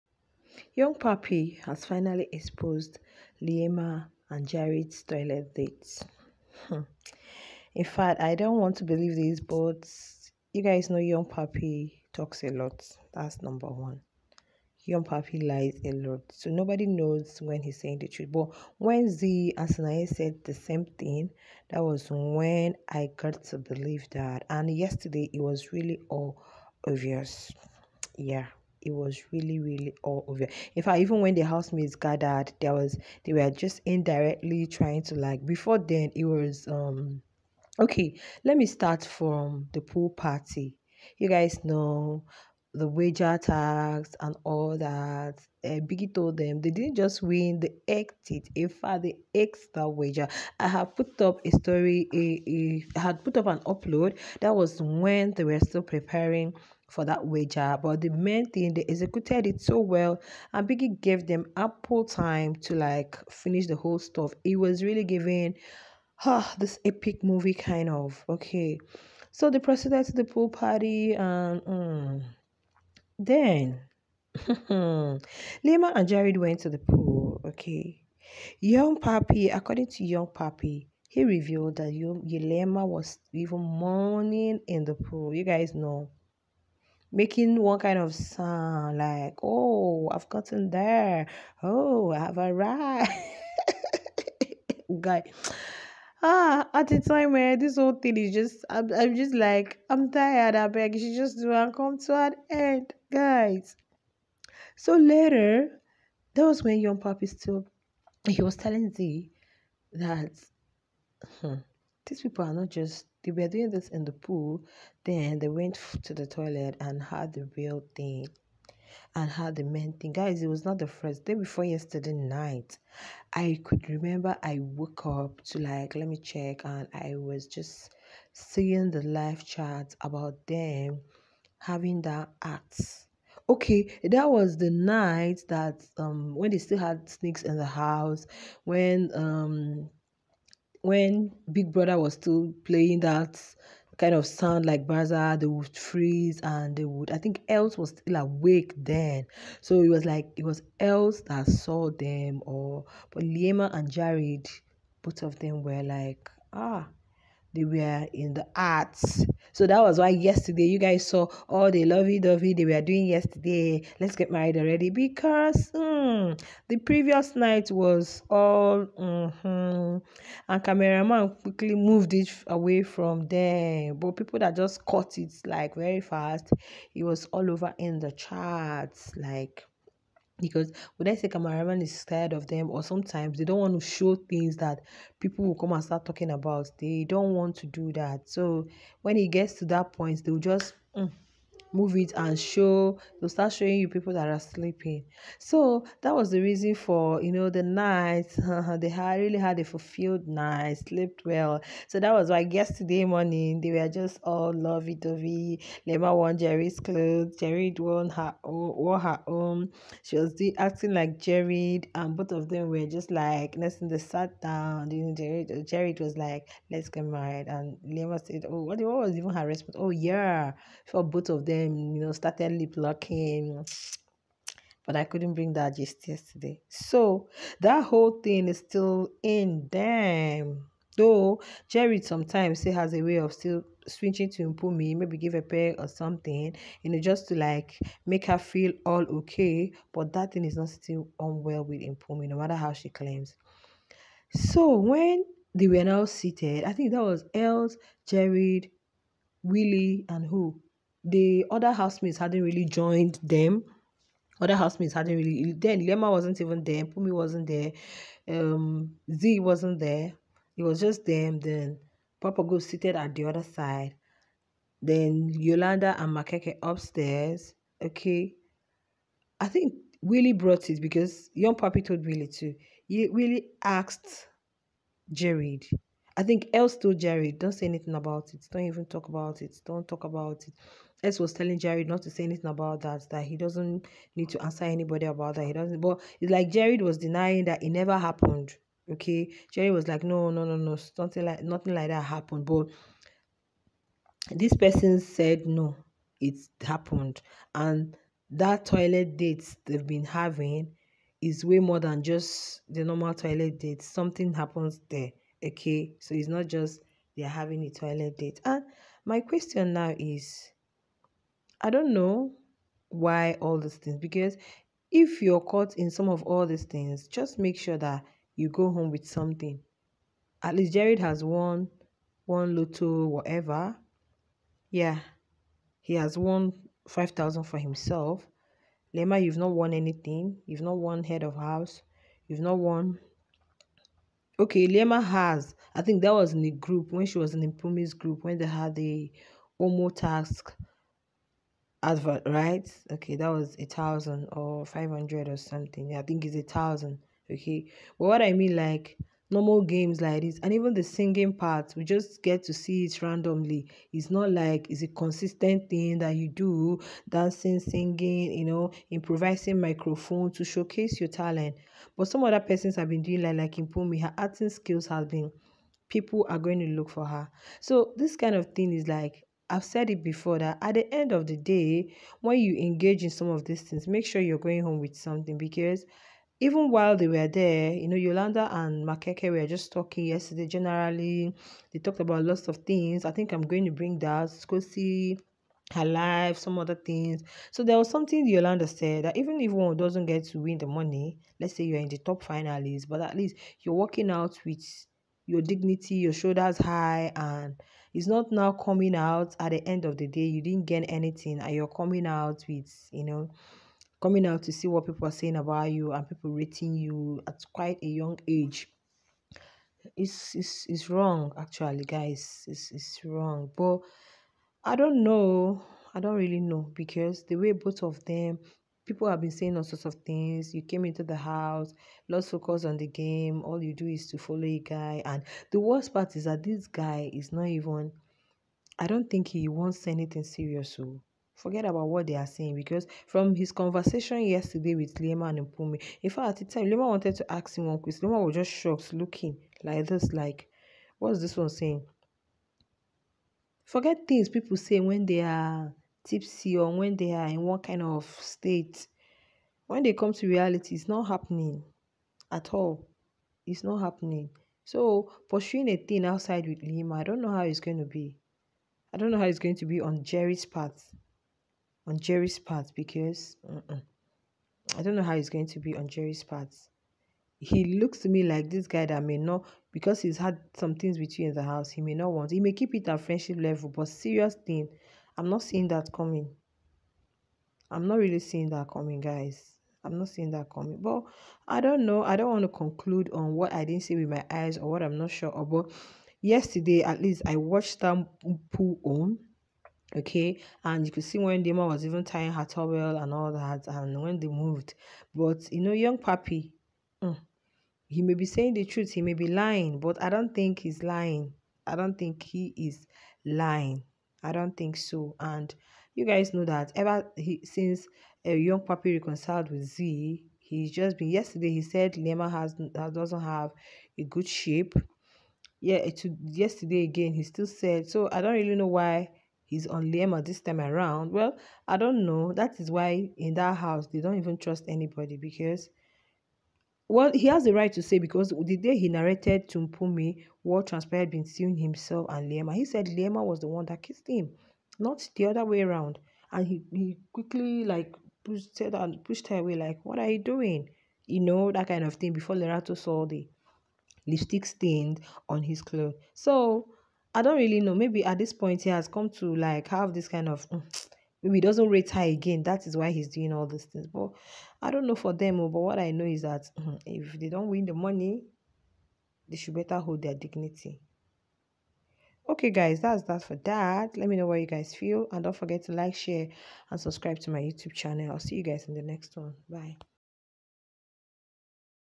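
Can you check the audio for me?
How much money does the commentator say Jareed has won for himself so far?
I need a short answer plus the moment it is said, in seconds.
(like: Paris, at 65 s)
5,000, at 326 s.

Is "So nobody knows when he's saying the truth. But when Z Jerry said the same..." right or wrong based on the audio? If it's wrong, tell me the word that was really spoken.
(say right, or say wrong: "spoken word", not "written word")
wrong: "Asanaye", not "Jerry".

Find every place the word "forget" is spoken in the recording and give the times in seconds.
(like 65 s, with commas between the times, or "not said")
431 s, 443 s, 565 s.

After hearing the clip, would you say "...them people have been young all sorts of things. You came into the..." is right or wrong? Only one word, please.
wrong.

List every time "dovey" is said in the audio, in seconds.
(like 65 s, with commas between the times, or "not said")
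162 s, 204 s.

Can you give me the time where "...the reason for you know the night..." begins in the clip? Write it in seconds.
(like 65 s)
196 s.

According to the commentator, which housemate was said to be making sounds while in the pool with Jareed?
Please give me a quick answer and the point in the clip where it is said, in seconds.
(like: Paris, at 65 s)
Yelema, at 81 s.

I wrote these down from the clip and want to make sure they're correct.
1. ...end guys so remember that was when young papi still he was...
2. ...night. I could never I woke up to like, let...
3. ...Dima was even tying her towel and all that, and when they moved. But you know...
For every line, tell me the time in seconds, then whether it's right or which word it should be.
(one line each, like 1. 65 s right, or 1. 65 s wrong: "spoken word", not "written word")
1. 102 s wrong: "later", not "remember"
2. 122 s wrong: "remember", not "never"
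3. 491 s right.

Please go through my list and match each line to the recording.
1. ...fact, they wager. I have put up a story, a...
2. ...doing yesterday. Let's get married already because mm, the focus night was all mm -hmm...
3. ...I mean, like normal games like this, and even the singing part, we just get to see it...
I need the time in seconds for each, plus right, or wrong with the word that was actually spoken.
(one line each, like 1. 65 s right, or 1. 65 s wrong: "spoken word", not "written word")
1. 48 s right
2. 162 s wrong: "previous", not "focus"
3. 348 s right.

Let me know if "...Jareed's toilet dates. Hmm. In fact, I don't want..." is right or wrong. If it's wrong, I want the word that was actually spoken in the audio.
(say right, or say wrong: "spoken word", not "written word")
right.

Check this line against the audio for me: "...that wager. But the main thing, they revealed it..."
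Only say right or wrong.
wrong.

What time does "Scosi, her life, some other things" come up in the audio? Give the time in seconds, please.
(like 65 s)
384 s.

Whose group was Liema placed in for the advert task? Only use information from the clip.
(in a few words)
Pumi's group.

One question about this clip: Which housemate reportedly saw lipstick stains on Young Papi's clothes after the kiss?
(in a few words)
Lerato.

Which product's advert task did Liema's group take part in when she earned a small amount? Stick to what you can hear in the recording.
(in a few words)
Omo.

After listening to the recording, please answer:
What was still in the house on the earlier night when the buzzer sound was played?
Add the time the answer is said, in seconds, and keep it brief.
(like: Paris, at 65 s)
snakes, at 137 s.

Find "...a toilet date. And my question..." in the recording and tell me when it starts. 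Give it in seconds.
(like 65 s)
307 s.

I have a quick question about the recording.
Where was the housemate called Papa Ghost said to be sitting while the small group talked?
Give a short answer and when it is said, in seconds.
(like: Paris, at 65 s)
the other side, at 263 s.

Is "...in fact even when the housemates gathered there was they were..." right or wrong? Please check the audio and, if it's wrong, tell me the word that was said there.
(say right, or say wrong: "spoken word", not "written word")
right.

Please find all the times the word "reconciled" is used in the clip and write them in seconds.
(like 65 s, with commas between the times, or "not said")
508 s.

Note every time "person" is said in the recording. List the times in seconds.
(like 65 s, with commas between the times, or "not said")
294 s, 362 s.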